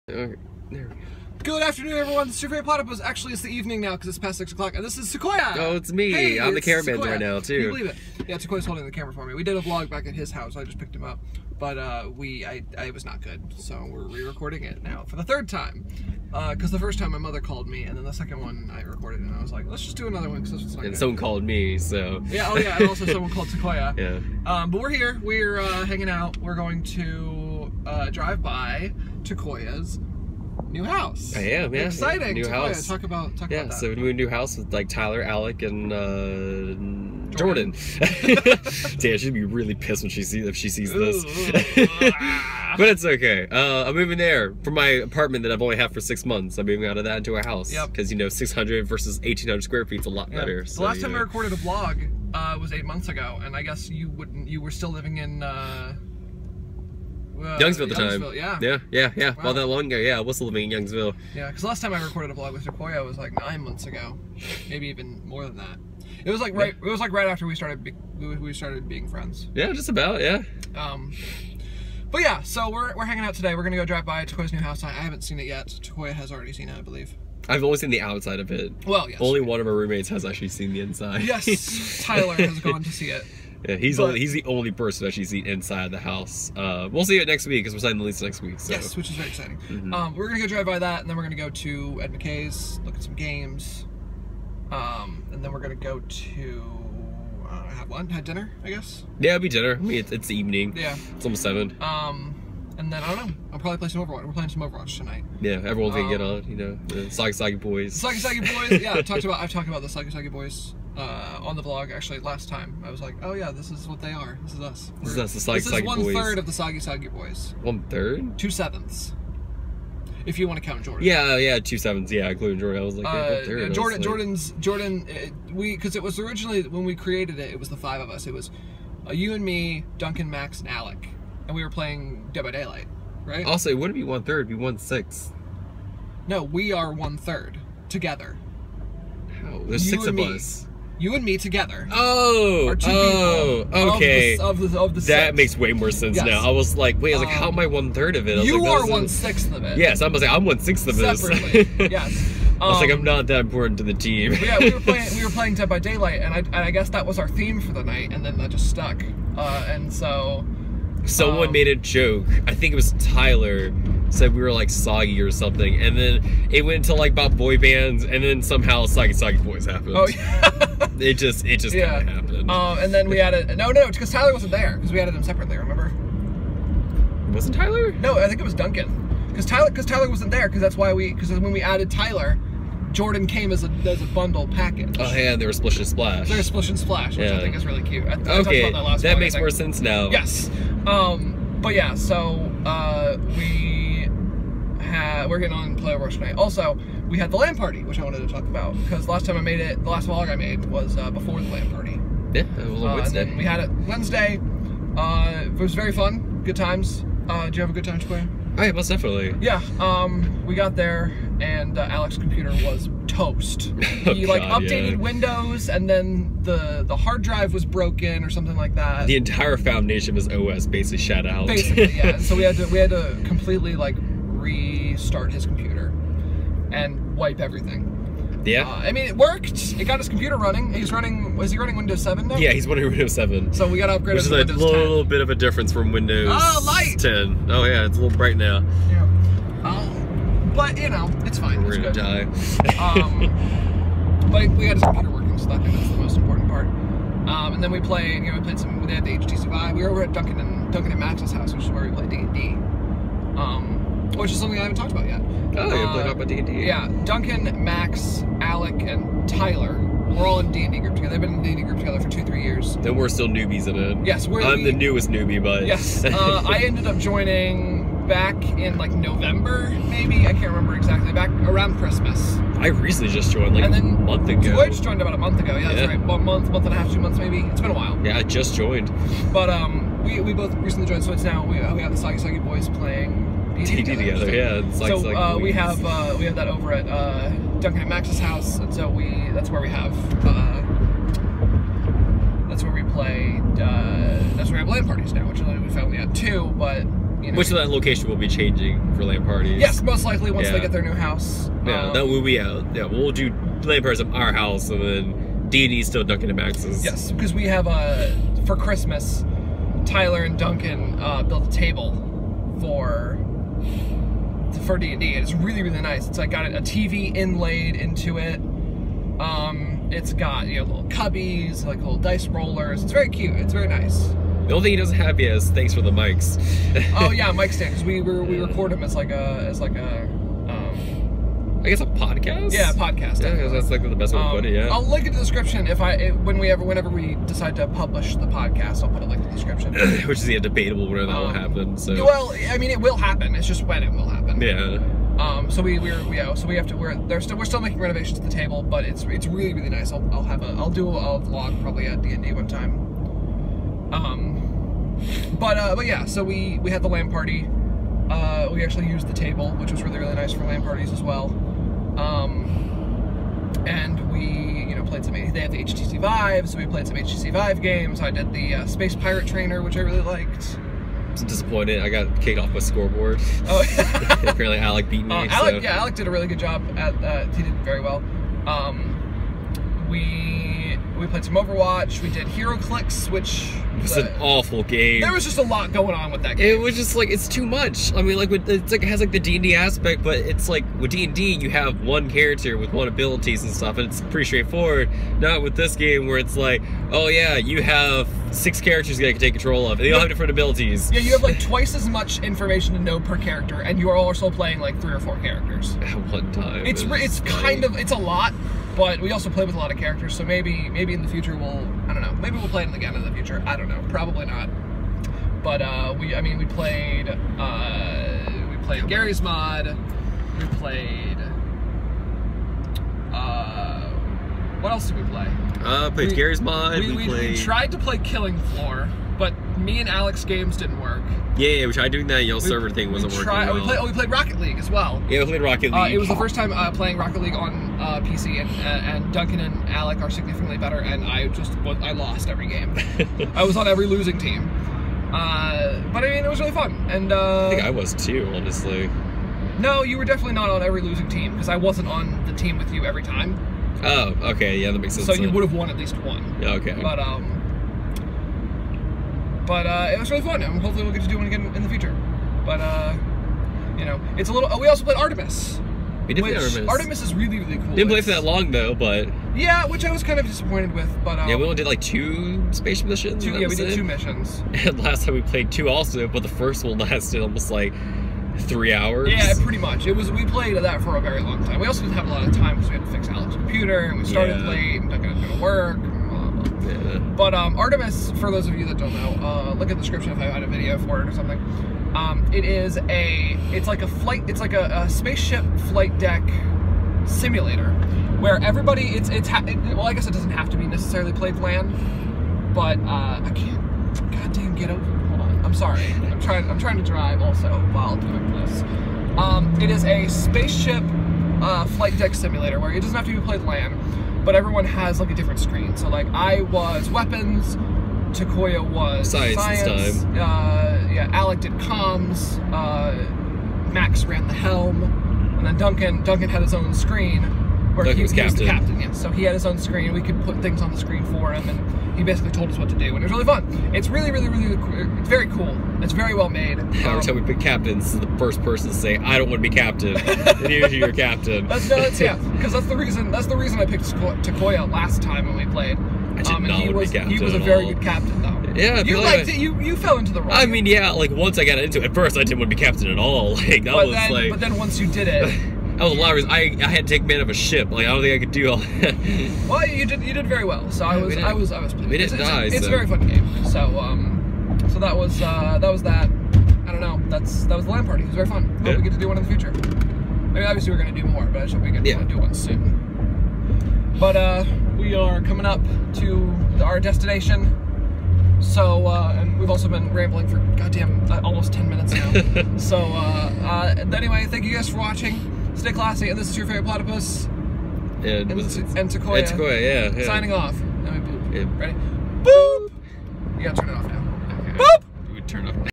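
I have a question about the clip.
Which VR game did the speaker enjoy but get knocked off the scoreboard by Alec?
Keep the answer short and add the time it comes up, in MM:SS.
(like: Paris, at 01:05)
Space Pirate Trainer, at 06:08.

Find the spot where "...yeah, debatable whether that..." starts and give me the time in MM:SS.
05:40.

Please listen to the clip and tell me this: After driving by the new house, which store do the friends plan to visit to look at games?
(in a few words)
Ed McKay's.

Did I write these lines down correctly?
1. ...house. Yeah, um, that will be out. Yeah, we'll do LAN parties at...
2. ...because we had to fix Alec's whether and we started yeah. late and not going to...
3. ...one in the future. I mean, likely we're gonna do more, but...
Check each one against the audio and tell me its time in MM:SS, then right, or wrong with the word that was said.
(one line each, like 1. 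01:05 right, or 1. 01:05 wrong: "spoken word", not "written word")
1. 05:00 right
2. 08:02 wrong: "computer", not "whether"
3. 09:29 wrong: "obviously", not "likely".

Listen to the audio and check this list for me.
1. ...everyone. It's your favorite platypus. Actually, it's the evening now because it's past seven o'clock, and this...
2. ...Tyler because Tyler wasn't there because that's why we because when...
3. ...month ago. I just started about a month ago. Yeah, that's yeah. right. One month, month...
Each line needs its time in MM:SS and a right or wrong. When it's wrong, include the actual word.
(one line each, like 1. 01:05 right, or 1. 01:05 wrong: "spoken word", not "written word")
1. 00:01 wrong: "six", not "seven"
2. 02:59 right
3. 04:33 wrong: "joined", not "started".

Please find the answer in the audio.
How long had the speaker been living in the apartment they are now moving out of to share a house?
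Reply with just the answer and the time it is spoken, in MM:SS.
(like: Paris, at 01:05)
6 months, at 00:46.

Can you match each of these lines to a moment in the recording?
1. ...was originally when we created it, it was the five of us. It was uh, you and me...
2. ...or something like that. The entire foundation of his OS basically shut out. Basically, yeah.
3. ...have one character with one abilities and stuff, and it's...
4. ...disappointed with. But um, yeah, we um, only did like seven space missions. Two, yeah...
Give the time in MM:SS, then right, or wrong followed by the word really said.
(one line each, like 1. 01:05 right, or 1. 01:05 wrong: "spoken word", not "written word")
1. 02:06 right
2. 03:38 right
3. 06:31 right
4. 07:50 wrong: "two", not "seven".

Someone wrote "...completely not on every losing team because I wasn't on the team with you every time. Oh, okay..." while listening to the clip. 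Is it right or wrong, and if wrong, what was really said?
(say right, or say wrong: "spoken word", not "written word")
wrong: "definitely", not "completely".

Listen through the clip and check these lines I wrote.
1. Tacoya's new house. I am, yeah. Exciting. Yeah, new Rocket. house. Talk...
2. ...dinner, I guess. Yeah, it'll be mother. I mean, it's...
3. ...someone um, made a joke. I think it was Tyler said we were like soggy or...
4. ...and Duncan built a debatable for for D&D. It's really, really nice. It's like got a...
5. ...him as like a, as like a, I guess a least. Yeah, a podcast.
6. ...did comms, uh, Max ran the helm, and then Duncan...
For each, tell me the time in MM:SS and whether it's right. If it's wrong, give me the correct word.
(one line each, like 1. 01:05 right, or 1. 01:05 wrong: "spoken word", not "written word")
1. 00:29 wrong: "Tacoya", not "Rocket"
2. 01:38 wrong: "dinner", not "mother"
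3. 02:41 right
4. 05:10 wrong: "table", not "debatable"
5. 05:28 wrong: "podcast", not "least"
6. 08:41 right.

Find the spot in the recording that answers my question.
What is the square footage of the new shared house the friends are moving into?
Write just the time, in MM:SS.
00:49.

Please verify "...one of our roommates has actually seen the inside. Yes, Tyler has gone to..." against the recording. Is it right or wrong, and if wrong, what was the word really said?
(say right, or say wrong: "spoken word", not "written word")
right.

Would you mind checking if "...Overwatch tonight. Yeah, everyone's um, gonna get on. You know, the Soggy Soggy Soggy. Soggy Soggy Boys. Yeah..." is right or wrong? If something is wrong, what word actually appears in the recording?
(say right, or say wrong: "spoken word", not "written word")
wrong: "Boys", not "Soggy".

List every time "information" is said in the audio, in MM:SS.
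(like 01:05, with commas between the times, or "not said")
06:42.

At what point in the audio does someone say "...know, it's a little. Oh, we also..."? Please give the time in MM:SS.
07:43.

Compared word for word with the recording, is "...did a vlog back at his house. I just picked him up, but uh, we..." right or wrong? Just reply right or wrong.
right.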